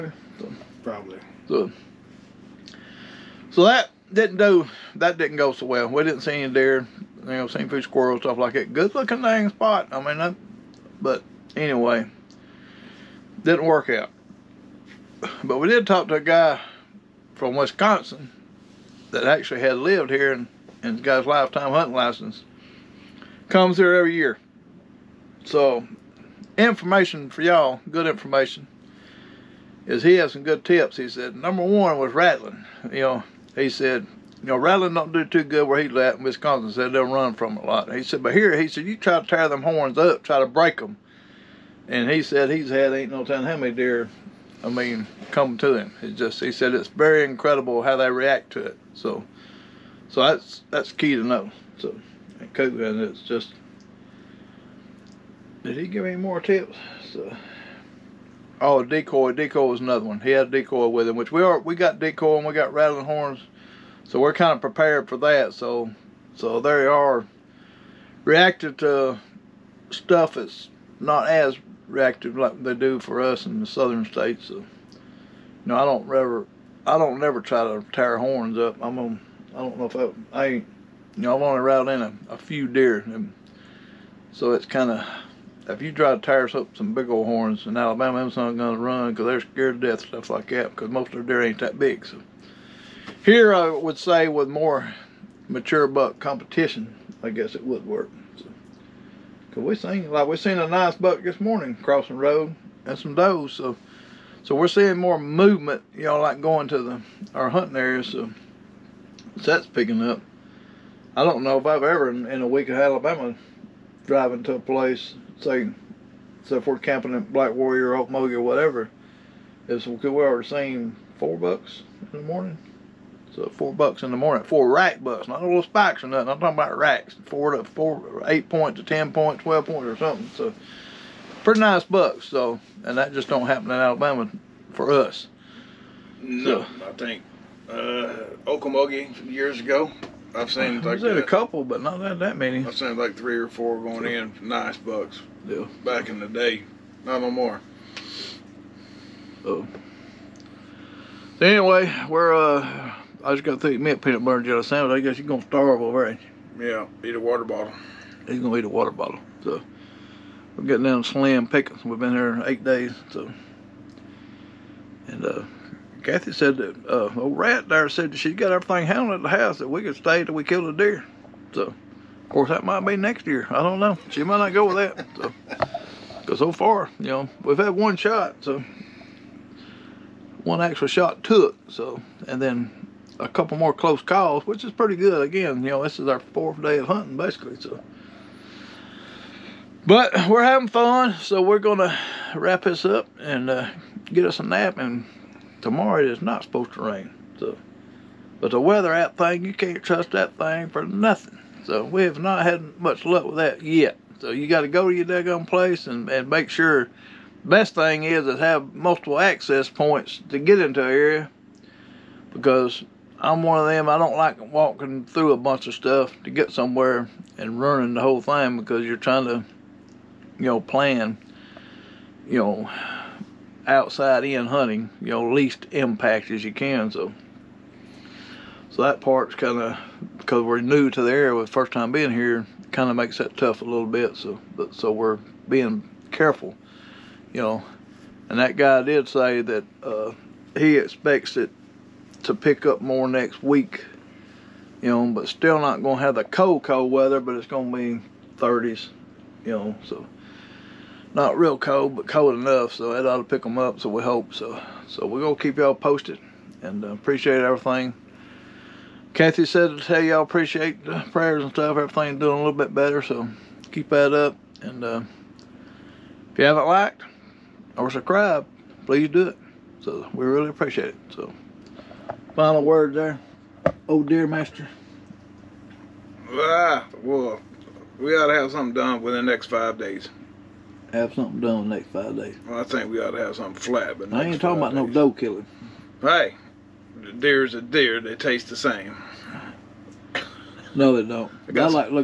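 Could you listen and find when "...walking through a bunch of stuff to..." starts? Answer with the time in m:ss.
3:34.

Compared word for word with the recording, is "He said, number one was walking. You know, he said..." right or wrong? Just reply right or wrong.
wrong.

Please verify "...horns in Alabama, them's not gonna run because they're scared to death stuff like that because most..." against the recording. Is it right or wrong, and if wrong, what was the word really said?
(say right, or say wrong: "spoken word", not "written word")
right.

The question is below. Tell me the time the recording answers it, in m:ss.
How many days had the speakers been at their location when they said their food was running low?
2:42.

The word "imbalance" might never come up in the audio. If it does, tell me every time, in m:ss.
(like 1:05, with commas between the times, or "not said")
not said.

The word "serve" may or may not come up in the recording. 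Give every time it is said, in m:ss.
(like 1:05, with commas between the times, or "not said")
not said.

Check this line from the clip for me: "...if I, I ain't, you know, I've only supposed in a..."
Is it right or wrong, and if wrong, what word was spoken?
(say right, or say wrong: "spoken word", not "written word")
wrong: "riled", not "supposed".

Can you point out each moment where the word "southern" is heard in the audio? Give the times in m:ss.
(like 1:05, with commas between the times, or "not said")
1:13.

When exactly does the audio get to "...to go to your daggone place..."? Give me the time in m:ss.
3:24.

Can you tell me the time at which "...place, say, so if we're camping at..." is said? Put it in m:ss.
1:54.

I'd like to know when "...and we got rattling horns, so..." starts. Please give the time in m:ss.
1:02.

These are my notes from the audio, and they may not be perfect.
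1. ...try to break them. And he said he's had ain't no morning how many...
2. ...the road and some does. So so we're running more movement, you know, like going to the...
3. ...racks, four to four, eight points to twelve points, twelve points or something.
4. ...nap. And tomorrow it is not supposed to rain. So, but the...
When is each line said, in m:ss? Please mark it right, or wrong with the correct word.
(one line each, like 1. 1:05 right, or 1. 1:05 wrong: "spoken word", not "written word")
1. 0:40 wrong: "telling", not "morning"
2. 1:42 wrong: "seeing", not "running"
3. 2:06 wrong: "ten", not "twelve"
4. 3:14 right.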